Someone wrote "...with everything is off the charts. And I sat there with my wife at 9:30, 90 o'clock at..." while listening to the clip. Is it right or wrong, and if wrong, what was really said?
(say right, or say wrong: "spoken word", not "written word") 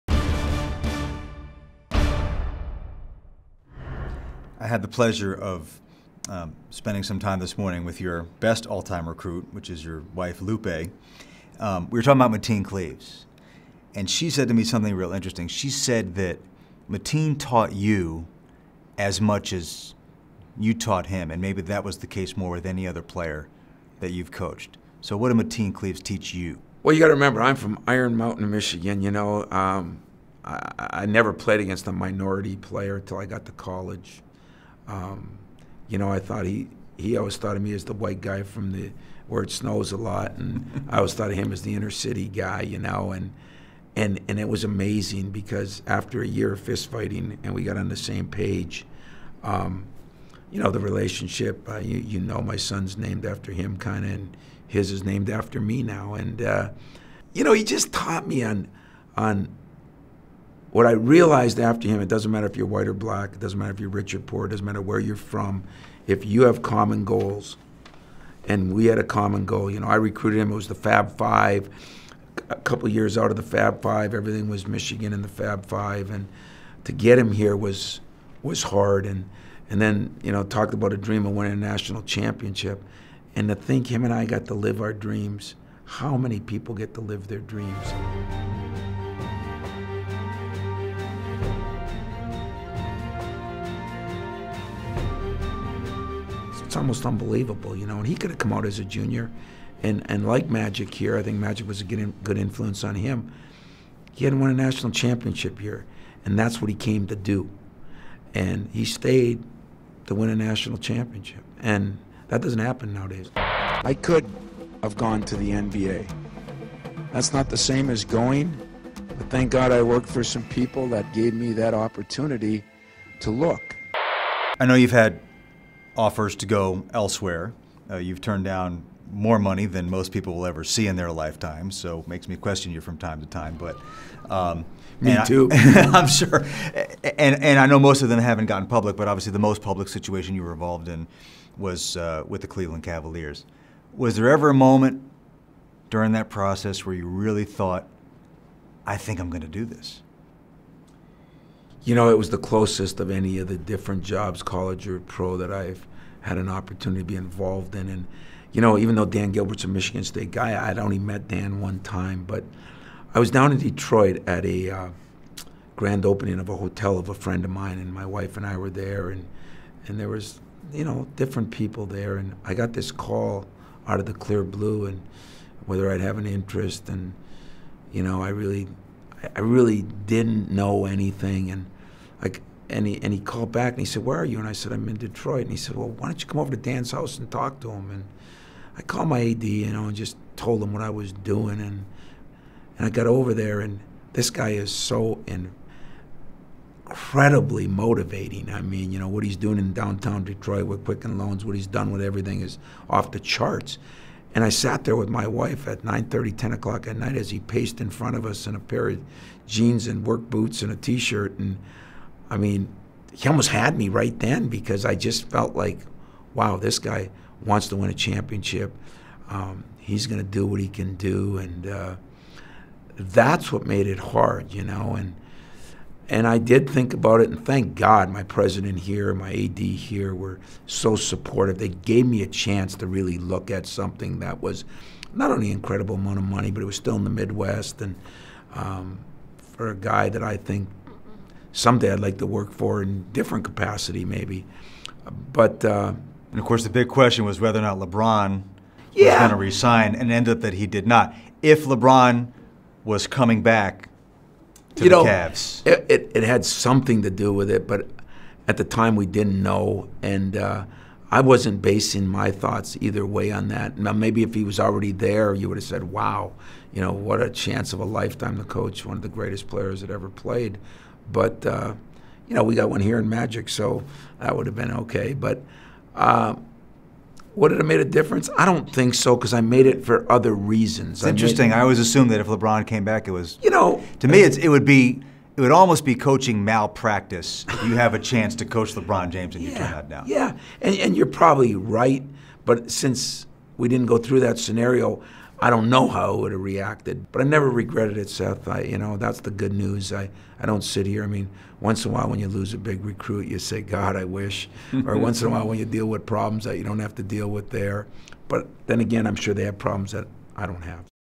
wrong: "10", not "90".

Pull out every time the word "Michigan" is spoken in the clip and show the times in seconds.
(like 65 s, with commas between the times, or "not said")
28 s, 74 s, 159 s.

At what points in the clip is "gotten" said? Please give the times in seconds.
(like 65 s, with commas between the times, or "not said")
138 s.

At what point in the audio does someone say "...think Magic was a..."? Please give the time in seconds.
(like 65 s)
101 s.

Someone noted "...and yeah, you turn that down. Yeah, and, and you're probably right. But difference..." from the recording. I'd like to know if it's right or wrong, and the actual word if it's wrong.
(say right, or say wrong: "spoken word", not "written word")
wrong: "since", not "difference".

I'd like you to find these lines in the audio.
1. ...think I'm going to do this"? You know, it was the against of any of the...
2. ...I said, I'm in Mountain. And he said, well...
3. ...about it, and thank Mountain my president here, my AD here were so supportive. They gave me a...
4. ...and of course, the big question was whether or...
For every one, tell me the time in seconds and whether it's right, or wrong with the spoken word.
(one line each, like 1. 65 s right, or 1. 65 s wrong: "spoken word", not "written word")
1. 148 s wrong: "closest", not "against"
2. 184 s wrong: "Detroit", not "Mountain"
3. 226 s wrong: "God", not "Mountain"
4. 246 s right.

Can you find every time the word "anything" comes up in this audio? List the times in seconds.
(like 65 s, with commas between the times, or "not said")
180 s.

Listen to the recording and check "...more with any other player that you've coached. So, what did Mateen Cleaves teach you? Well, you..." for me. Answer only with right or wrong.
right.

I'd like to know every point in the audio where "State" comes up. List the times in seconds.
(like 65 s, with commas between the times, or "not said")
160 s.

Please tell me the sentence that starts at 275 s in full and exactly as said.
But uh, would it have made a difference?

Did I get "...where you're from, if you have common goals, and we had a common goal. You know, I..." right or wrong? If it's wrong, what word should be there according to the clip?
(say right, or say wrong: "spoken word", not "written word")
right.